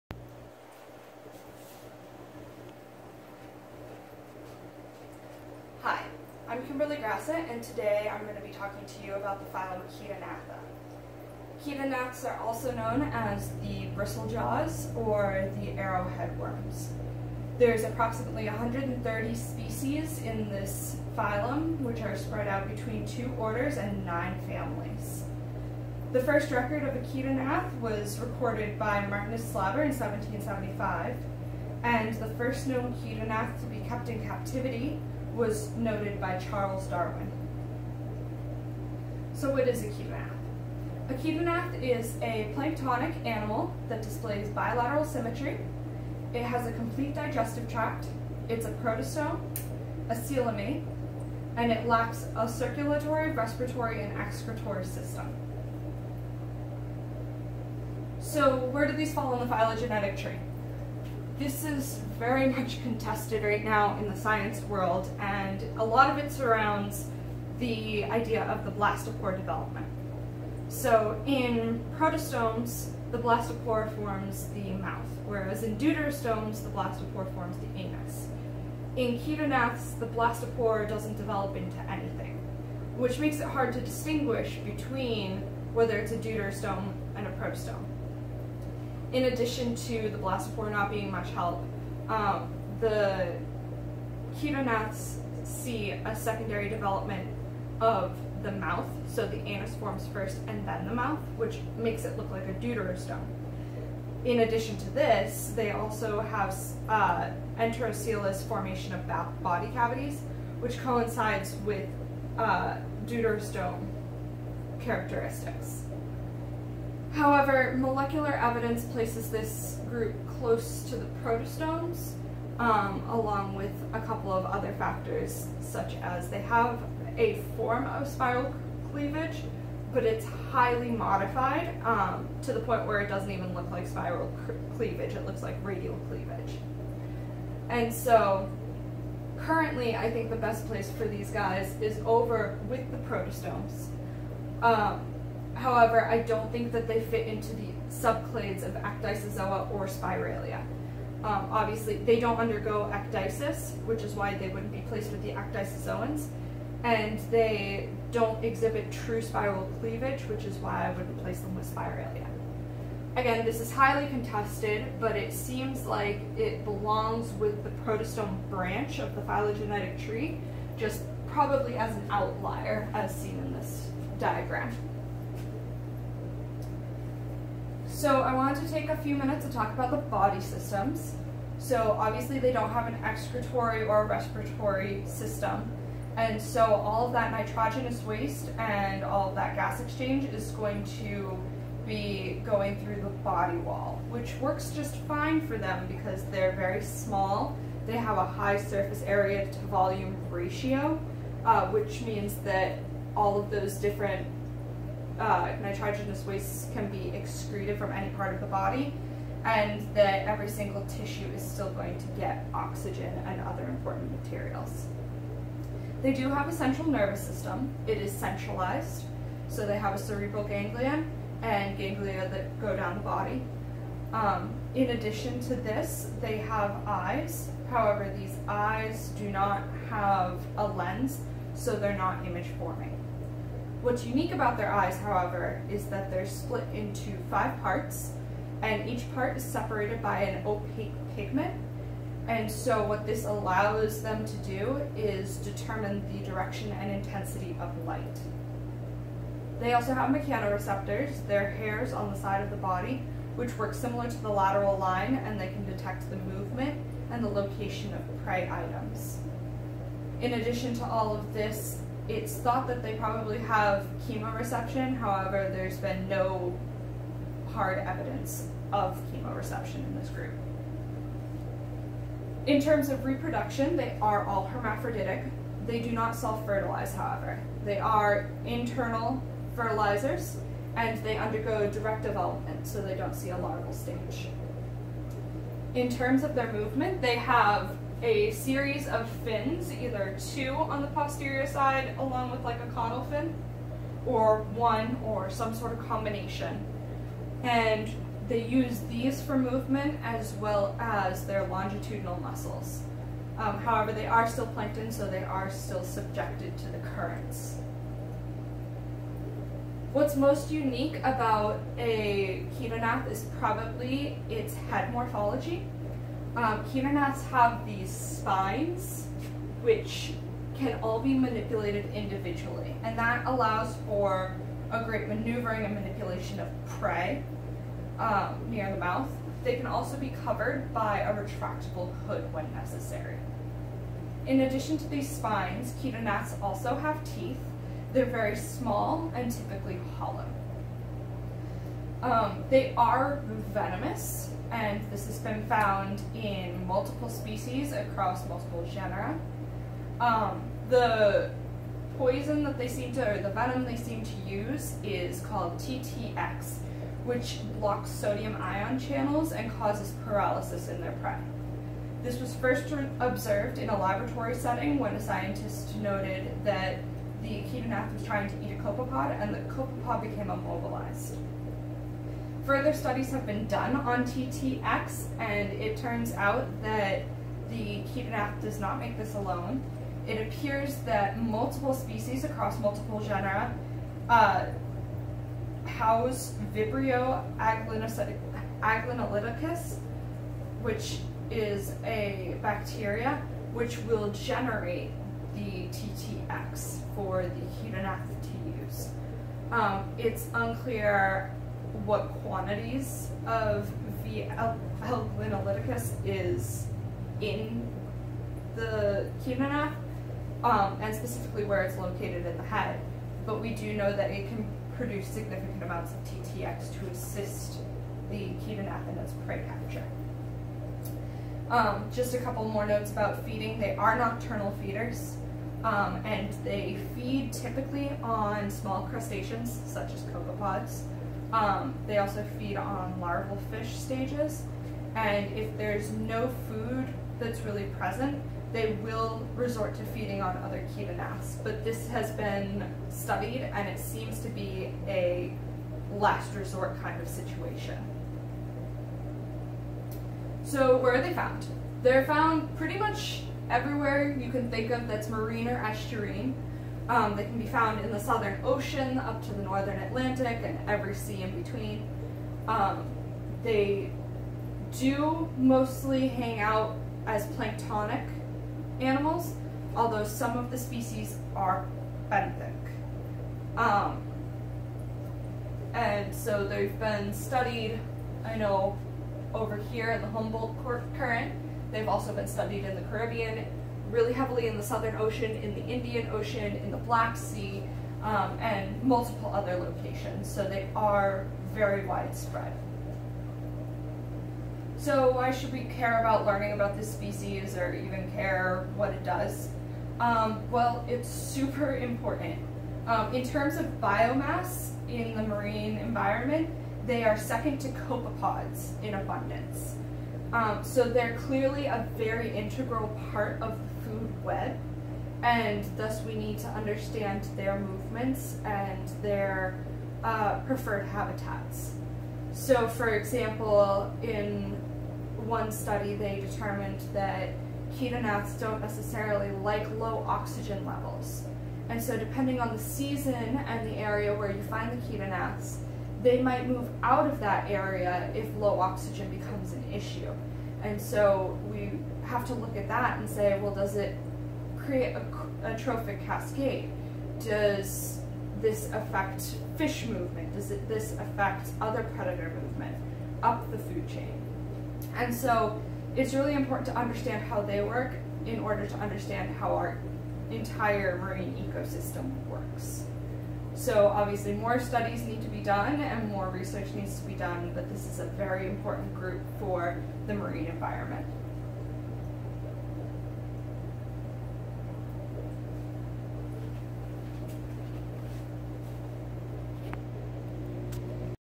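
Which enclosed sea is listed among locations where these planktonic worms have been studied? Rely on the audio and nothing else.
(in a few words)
Black Sea.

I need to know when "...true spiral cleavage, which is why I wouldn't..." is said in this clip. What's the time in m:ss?
2:38.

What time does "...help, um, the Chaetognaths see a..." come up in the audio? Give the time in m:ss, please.
1:31.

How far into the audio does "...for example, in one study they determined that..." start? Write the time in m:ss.
8:42.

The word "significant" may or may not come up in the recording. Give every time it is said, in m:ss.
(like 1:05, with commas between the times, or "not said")
6:55.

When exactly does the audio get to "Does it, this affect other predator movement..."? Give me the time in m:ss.
9:10.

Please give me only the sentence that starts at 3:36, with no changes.
They do have a central nervous system.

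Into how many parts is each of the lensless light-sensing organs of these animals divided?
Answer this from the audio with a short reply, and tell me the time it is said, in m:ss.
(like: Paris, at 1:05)
5, at 3:57.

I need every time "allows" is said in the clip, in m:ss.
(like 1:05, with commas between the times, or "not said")
4:03, 5:23.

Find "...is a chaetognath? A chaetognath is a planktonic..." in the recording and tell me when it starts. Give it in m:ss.
0:39.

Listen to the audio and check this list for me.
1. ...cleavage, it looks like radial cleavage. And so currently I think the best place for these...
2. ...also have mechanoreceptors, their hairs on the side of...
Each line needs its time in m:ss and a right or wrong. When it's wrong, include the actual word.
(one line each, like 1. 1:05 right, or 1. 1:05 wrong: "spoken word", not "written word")
1. 2:14 right
2. 4:09 right.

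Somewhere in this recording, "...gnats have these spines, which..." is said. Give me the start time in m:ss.
5:16.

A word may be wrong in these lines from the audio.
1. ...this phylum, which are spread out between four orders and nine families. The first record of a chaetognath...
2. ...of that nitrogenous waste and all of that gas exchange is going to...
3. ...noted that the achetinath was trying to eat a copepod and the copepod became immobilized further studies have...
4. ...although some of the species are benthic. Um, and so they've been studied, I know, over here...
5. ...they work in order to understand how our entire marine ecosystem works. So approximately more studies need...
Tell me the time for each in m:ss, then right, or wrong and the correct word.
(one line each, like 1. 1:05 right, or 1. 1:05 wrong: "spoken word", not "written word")
1. 0:20 wrong: "two", not "four"
2. 3:07 right
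3. 6:05 right
4. 7:49 right
5. 9:17 wrong: "obviously", not "approximately".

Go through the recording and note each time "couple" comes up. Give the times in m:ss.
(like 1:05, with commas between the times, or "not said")
2:04, 7:02.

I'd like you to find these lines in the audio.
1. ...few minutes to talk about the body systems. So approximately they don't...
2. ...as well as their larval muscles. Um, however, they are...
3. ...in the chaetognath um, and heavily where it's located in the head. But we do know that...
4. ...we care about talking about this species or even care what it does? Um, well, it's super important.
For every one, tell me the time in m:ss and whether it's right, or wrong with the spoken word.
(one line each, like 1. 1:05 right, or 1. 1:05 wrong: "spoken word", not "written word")
1. 2:58 wrong: "obviously", not "approximately"
2. 5:00 wrong: "longitudinal", not "larval"
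3. 6:47 wrong: "specifically", not "heavily"
4. 8:15 wrong: "learning", not "talking".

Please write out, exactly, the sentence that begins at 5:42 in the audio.
Um, they are venomous, and this has been found in multiple species across multiple genera.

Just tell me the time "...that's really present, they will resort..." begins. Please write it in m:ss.
7:17.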